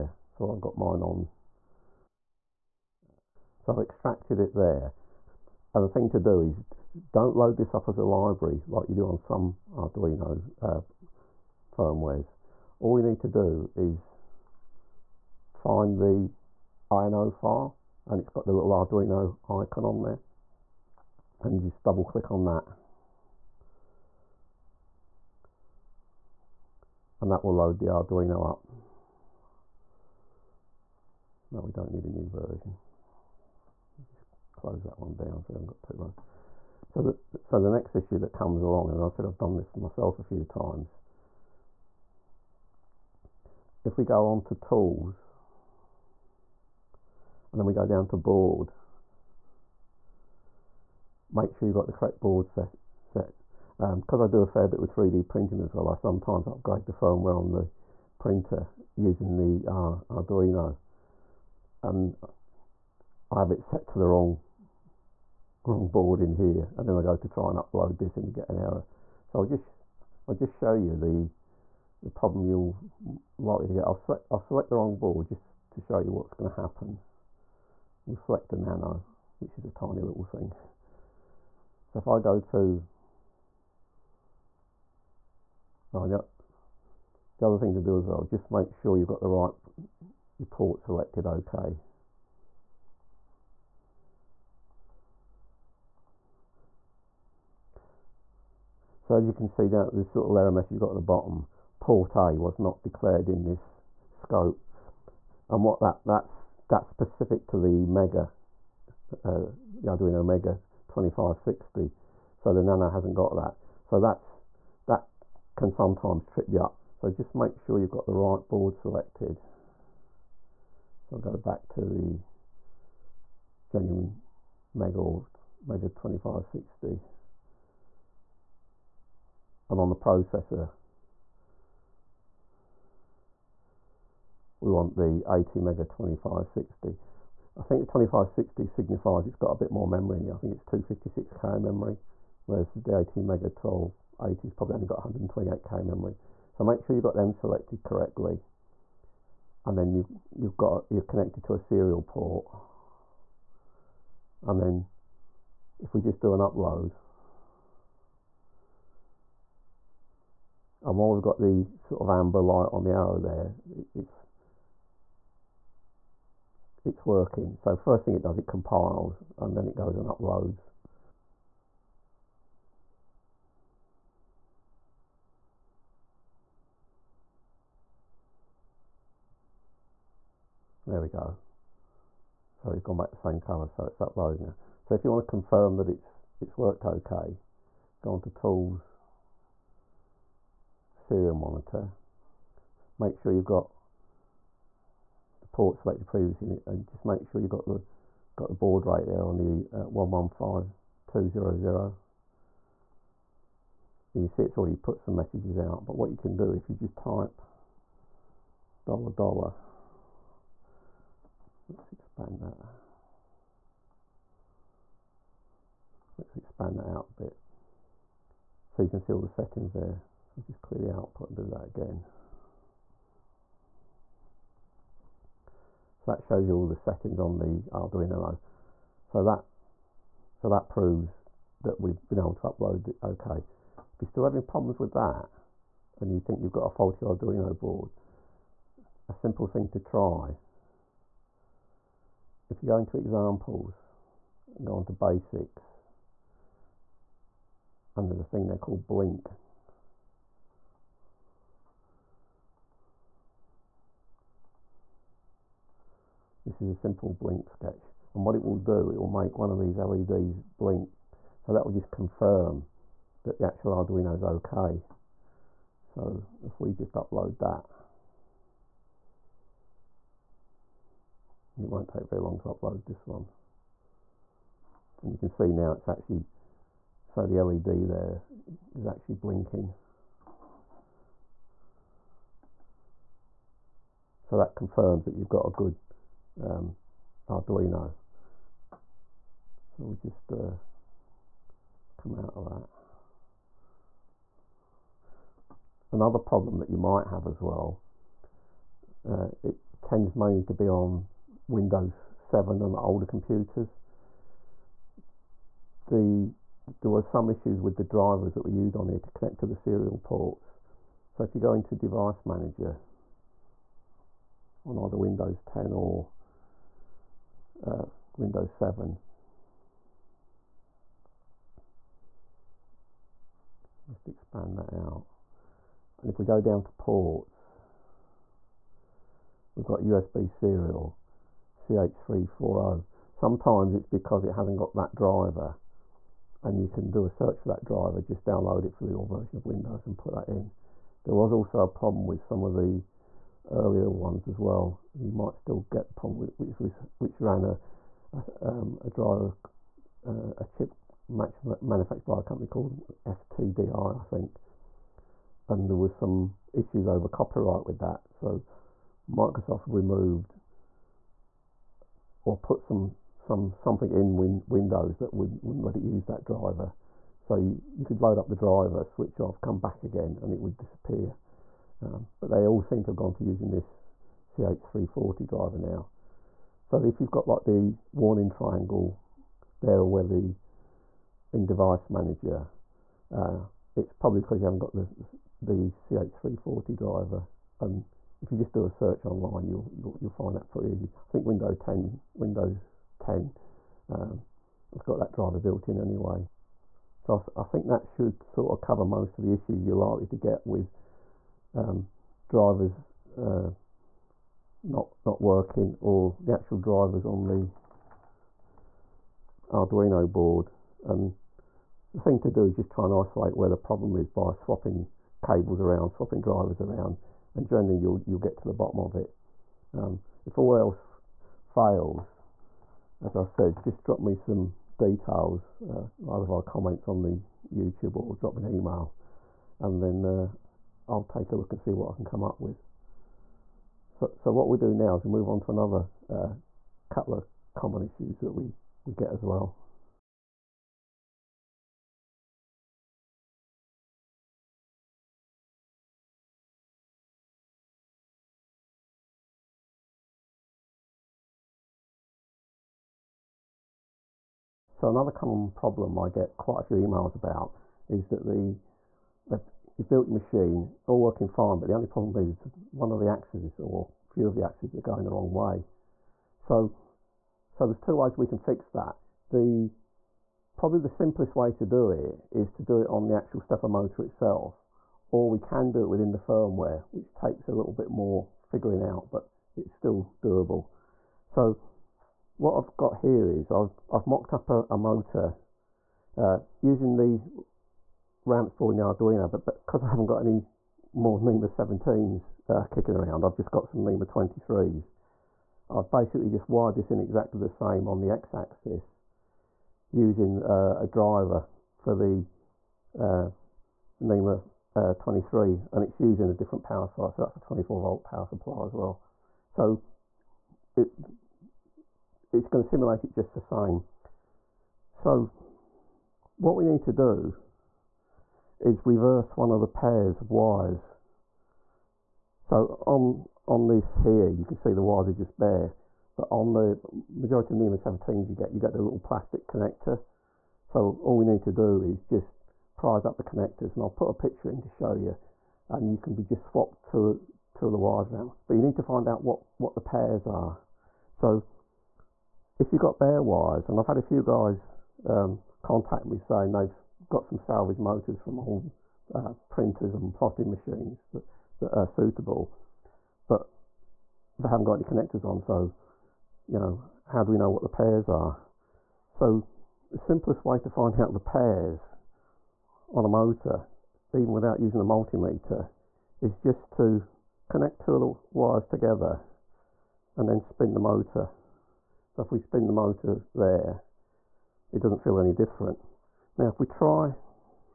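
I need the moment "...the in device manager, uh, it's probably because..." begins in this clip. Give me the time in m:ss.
6:20.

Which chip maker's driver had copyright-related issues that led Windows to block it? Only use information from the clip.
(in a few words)
FTDI.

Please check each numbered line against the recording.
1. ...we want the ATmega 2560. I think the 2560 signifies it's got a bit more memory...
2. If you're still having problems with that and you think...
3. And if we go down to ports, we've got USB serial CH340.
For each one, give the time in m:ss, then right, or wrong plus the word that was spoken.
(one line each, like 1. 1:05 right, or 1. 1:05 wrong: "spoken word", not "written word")
1. 2:14 right
2. 3:53 right
3. 5:26 right.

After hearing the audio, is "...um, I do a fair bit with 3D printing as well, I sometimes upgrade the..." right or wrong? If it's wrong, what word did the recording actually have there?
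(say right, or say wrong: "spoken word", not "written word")
right.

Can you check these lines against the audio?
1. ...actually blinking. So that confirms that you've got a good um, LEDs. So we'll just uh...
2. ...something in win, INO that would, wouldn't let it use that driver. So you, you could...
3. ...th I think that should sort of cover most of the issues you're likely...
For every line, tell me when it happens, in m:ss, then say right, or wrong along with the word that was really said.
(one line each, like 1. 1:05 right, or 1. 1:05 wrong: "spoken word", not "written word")
1. 4:38 wrong: "Arduino", not "LEDs"
2. 6:03 wrong: "Windows", not "INO"
3. 6:37 right.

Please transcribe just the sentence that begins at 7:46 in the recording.
So, so there's two ways we can fix that.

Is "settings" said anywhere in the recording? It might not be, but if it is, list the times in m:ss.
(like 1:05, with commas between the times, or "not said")
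3:39, 3:46.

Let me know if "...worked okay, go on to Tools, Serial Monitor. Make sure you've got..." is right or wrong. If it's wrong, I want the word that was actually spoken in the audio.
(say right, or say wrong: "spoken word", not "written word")
right.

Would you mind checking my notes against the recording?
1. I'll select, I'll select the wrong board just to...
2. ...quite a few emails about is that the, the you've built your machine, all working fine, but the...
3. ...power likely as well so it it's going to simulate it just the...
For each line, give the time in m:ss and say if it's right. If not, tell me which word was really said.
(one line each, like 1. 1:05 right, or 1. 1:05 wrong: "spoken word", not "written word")
1. 1:13 right
2. 7:36 right
3. 8:28 wrong: "supply", not "likely".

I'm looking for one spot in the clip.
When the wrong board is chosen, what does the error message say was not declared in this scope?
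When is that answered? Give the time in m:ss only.
1:41.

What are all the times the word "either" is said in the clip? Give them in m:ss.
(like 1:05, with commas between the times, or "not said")
5:14, 7:06.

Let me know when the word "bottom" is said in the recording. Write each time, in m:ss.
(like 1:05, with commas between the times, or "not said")
1:41, 6:58.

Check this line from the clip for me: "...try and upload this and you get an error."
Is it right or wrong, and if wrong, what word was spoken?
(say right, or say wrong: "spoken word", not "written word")
right.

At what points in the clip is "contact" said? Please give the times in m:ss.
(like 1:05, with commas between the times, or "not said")
9:05.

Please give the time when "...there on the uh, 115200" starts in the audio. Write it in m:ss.
3:19.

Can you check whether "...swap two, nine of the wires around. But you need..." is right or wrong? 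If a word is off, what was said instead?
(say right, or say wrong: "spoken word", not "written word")
wrong: "two", not "nine".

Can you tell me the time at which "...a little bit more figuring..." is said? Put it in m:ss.
7:57.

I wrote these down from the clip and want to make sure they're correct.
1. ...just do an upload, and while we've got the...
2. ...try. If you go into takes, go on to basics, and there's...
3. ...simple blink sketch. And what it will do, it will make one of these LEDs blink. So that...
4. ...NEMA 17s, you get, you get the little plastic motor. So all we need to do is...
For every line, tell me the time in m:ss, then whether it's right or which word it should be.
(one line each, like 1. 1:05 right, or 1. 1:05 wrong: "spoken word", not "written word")
1. 2:36 right
2. 3:59 wrong: "examples", not "takes"
3. 4:16 right
4. 8:47 wrong: "connector", not "motor".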